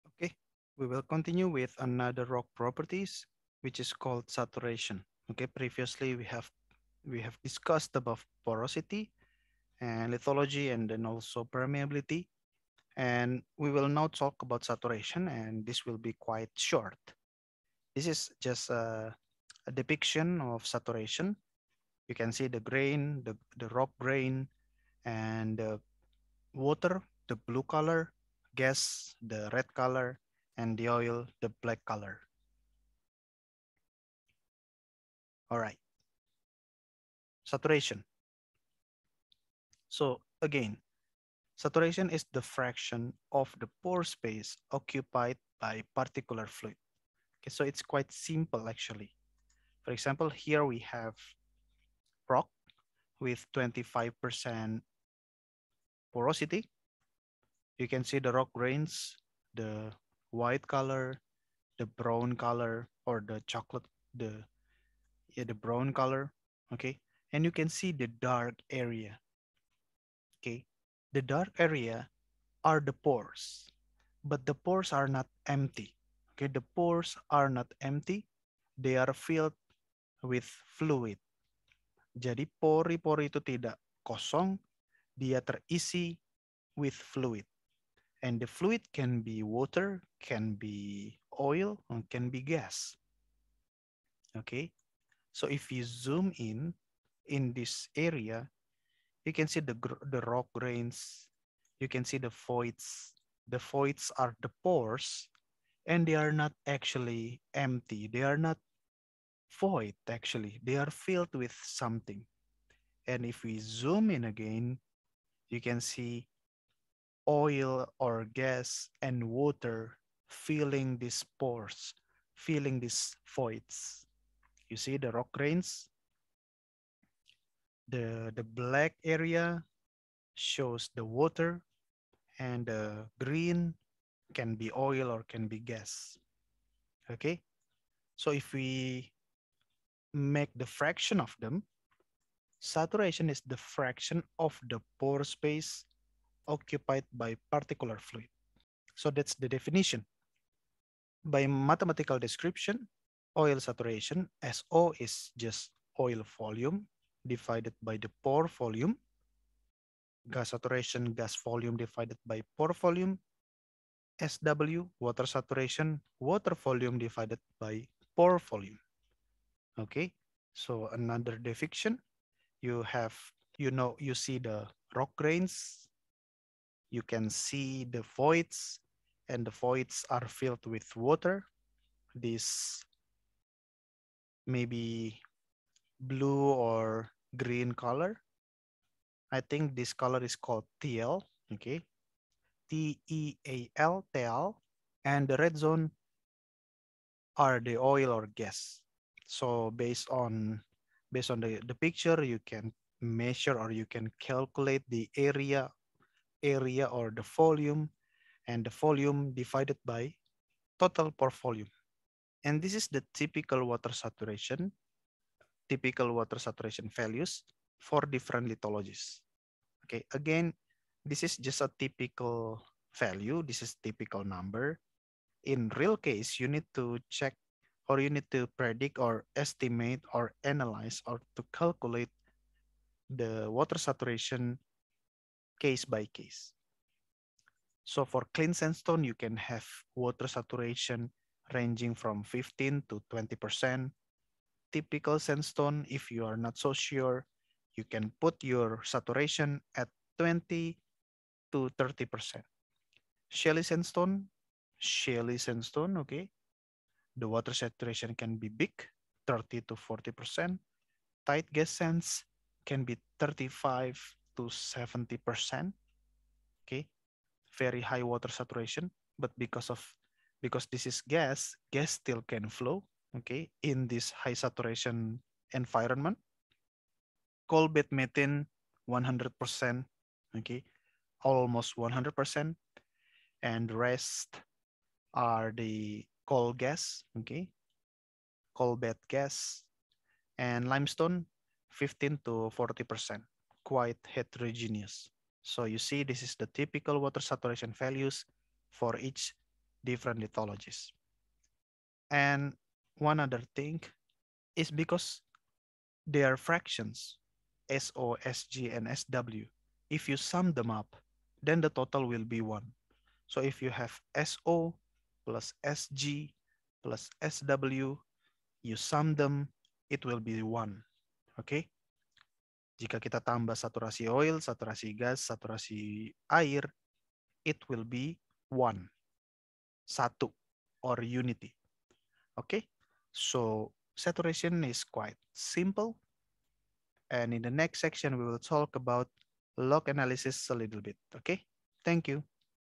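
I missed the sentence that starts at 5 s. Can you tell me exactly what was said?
Okay, previously we have we have discussed about porosity and lithology and then also permeability.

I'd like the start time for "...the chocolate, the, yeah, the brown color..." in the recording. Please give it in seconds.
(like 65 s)
63 s.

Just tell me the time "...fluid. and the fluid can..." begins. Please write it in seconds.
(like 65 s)
86 s.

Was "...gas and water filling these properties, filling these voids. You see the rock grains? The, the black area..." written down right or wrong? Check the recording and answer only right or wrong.
wrong.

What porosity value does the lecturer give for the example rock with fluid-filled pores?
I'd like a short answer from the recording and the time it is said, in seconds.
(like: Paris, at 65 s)
25%, at 53 s.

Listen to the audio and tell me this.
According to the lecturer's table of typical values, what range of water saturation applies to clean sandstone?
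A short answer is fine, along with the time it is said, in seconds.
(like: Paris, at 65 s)
15 to 20%, at 242 s.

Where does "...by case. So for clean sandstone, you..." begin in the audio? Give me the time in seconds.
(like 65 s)
235 s.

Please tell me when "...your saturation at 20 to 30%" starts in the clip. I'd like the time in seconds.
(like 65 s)
248 s.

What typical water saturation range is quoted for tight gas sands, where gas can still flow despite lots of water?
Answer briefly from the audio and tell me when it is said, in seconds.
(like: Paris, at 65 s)
35 to 70%, at 263 s.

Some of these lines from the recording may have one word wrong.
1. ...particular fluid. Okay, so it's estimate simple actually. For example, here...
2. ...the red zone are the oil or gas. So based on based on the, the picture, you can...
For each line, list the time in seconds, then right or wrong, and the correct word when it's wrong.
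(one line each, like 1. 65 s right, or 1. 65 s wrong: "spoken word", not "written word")
1. 45 s wrong: "quite", not "estimate"
2. 195 s right.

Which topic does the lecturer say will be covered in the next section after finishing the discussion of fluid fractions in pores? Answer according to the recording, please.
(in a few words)
log analysis.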